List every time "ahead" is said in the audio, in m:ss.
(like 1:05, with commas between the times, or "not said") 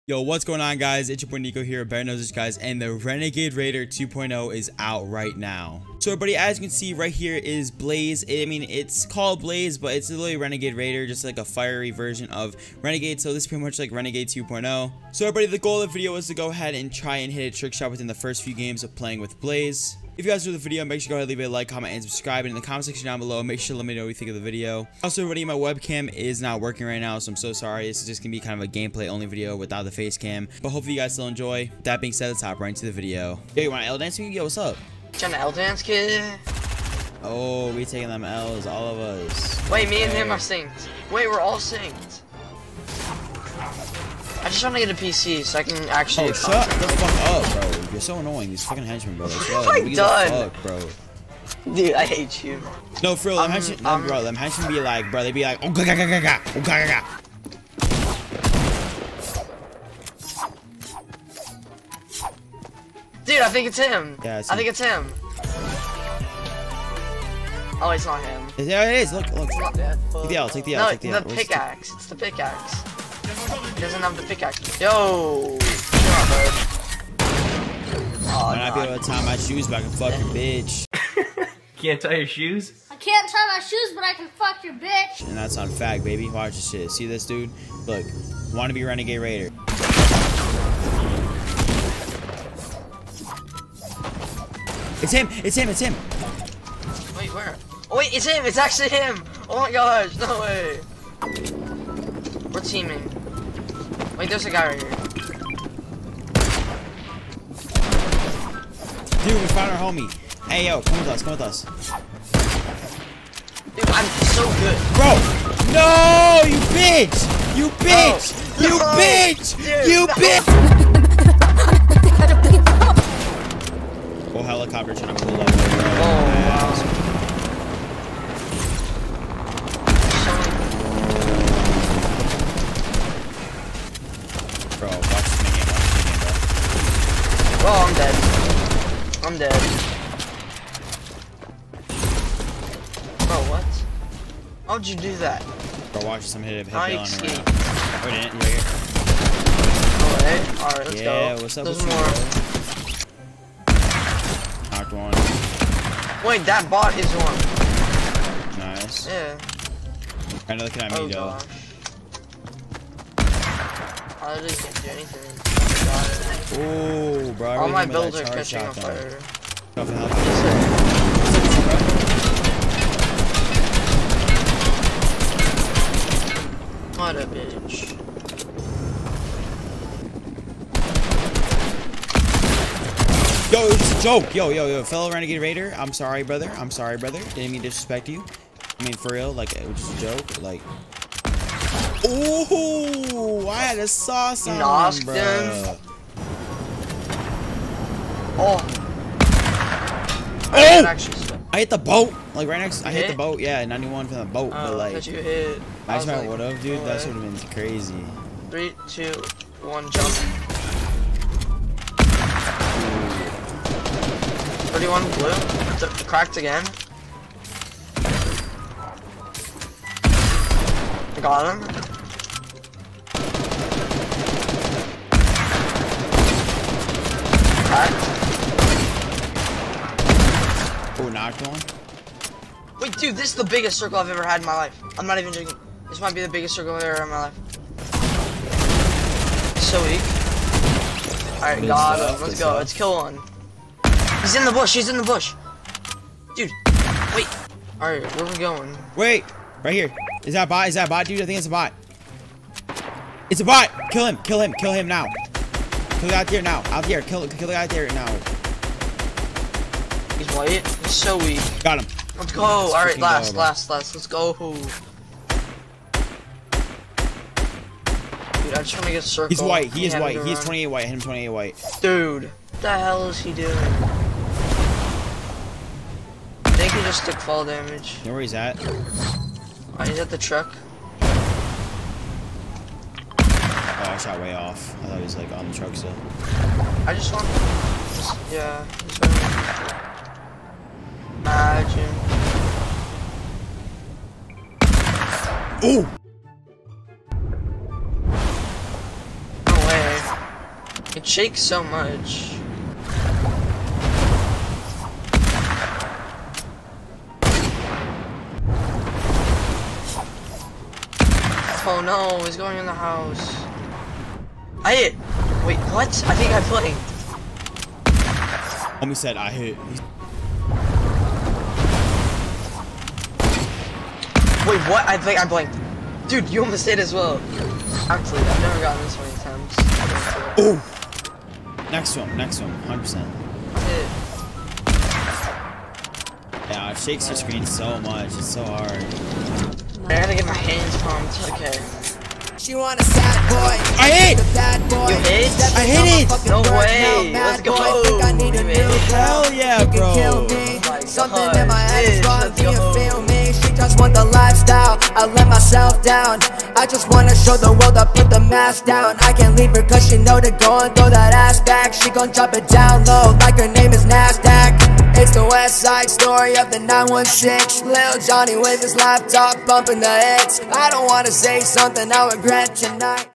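0:16, 0:21.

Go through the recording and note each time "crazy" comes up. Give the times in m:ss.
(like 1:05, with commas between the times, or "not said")
3:27.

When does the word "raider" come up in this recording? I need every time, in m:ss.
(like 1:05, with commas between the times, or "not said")
0:03, 0:10, 1:29, 3:05.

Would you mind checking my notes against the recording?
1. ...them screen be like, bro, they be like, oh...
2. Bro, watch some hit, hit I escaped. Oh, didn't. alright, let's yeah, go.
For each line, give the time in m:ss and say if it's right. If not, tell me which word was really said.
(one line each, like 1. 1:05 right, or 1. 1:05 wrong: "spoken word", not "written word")
1. 0:54 wrong: "henchmen", not "screen"
2. 2:25 right.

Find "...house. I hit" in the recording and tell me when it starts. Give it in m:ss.
5:12.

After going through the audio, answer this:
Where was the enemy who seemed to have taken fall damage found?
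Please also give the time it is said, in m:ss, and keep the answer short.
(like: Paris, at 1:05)
at the truck, at 4:39.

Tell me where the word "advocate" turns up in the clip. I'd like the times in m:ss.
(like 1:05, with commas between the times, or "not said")
not said.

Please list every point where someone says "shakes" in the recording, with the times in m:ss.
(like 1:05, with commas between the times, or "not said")
5:01, 5:36.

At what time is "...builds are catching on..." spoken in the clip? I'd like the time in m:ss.
2:47.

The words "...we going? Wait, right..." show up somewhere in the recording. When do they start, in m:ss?
4:08.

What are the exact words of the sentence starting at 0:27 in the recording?
This is just going to be kind of a gameplay-only video without the face cam.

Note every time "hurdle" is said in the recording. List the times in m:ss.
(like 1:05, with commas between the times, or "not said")
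not said.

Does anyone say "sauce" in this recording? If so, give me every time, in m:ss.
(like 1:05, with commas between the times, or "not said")
3:13.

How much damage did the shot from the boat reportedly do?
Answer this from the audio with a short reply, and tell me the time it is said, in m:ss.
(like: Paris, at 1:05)
91, at 3:23.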